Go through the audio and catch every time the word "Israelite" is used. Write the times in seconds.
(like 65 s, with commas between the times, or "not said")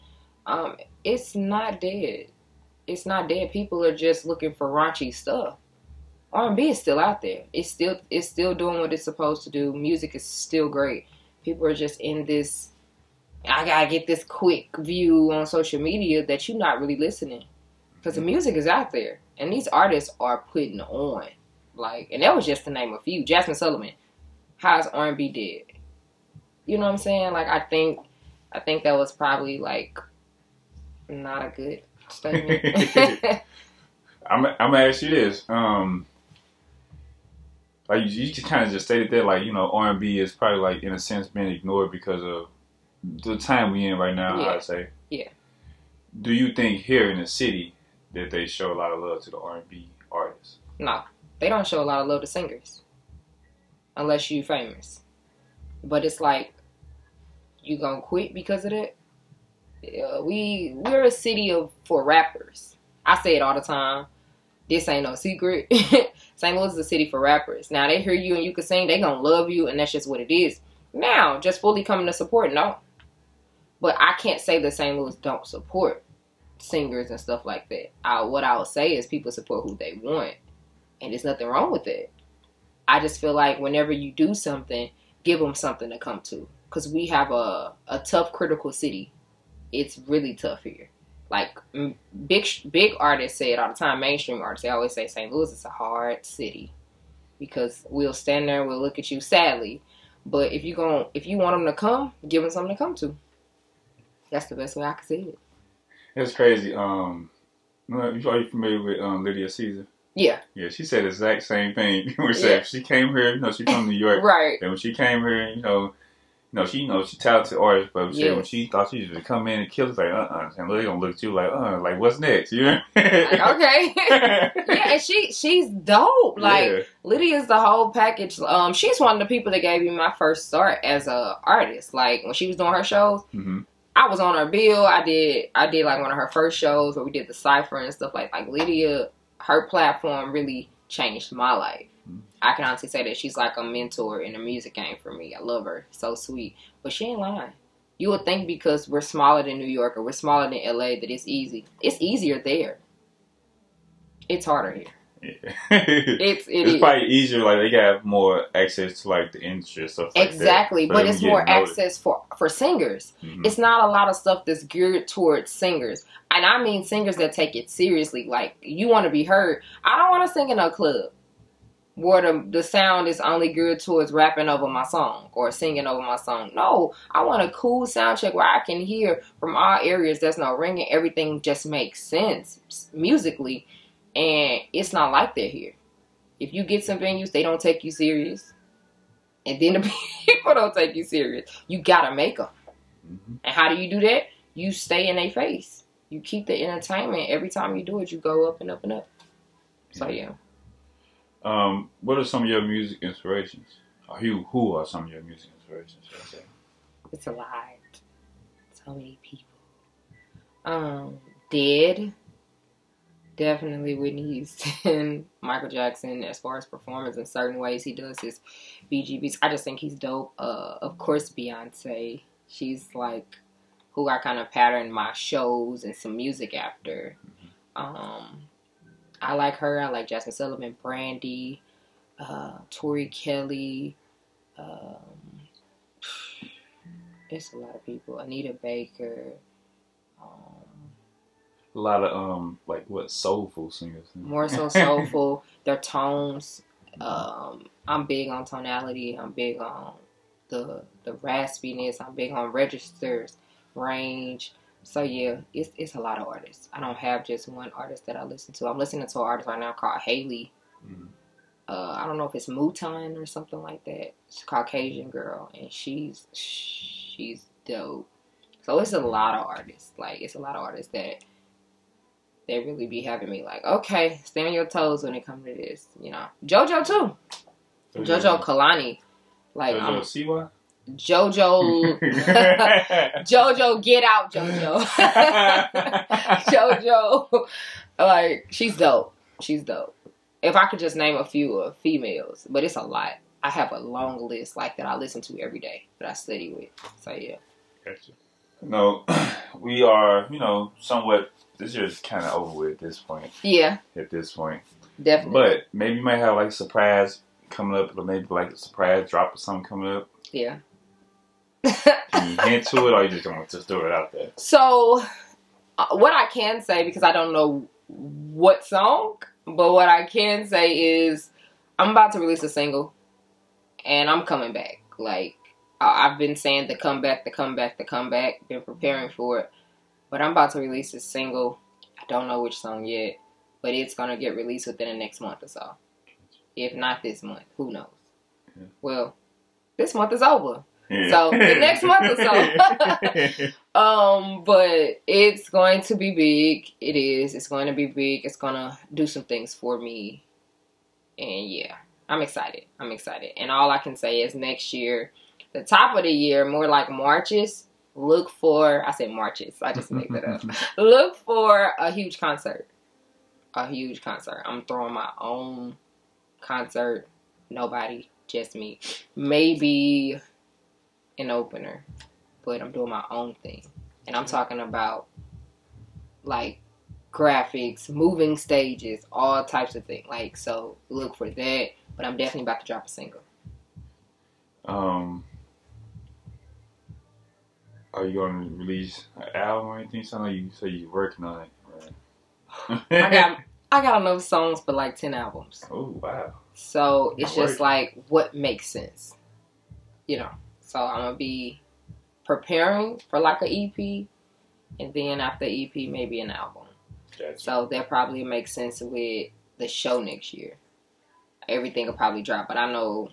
not said.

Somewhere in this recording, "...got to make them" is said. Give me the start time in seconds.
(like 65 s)
191 s.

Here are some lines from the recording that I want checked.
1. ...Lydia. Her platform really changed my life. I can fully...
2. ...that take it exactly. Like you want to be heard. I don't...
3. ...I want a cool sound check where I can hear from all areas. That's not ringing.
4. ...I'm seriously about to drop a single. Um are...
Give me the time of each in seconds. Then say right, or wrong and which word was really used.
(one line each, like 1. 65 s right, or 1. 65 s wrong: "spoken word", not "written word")
1. 138 s wrong: "honestly", not "fully"
2. 167 s wrong: "seriously", not "exactly"
3. 177 s right
4. 382 s wrong: "definitely", not "seriously".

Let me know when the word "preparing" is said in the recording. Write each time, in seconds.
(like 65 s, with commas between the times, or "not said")
328 s, 402 s.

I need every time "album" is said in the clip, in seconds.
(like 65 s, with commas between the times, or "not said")
389 s, 395 s, 406 s.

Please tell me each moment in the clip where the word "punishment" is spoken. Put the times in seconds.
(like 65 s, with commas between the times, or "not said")
not said.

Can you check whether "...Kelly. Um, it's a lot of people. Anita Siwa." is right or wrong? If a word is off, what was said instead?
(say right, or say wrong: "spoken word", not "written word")
wrong: "Baker", not "Siwa".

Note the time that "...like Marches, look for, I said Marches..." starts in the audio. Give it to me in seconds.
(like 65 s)
356 s.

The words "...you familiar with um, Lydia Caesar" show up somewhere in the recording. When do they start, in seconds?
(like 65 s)
108 s.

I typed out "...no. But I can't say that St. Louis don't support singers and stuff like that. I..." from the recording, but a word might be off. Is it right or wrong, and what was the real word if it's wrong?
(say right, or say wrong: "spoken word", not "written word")
right.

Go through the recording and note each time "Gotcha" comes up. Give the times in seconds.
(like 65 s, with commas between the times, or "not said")
297 s, 407 s.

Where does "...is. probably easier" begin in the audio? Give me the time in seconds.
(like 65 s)
156 s.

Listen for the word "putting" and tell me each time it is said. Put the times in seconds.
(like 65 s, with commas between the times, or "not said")
20 s.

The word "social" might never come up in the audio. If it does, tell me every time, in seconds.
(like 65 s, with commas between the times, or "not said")
15 s.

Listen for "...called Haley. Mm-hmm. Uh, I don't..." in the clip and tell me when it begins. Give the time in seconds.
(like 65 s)
259 s.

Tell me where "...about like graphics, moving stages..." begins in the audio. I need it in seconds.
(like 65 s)
374 s.